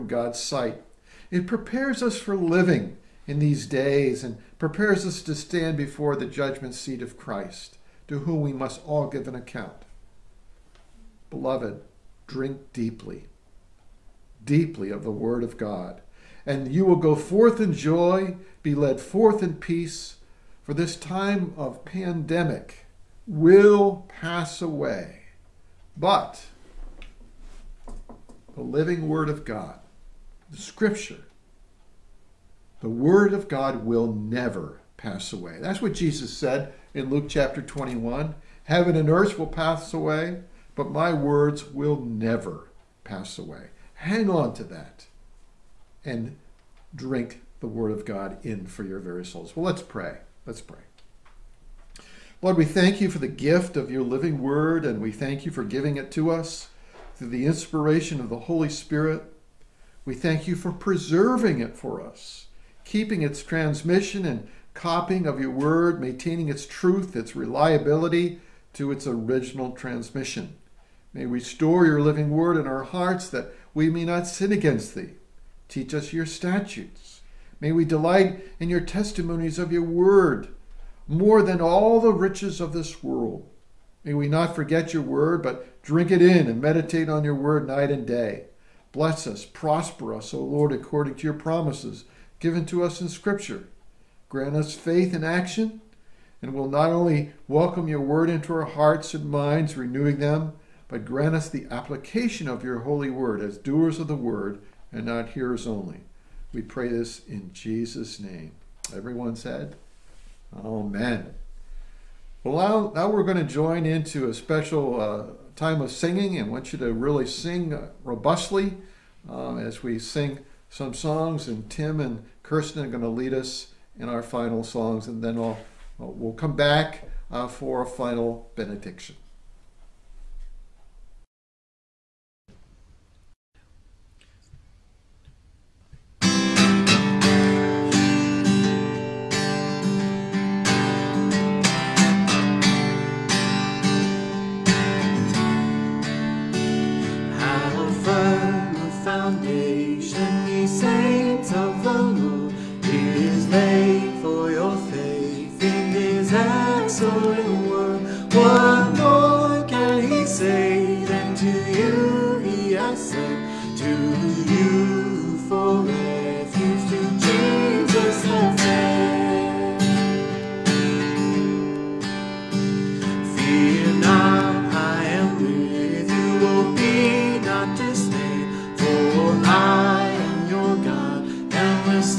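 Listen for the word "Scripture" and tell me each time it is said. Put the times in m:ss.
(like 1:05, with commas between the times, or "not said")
0:30, 1:33.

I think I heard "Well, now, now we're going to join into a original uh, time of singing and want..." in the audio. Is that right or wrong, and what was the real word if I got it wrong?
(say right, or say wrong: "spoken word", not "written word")
wrong: "special", not "original".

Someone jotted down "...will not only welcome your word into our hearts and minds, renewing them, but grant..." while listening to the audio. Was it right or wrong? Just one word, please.
right.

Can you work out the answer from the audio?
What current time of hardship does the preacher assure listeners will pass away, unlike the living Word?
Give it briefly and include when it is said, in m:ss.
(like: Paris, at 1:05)
Pandemic, at 0:21.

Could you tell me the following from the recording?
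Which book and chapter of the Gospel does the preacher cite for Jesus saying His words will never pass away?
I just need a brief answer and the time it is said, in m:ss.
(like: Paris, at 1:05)
Luke 21, at 0:37.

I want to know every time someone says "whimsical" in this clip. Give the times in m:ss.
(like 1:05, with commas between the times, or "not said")
not said.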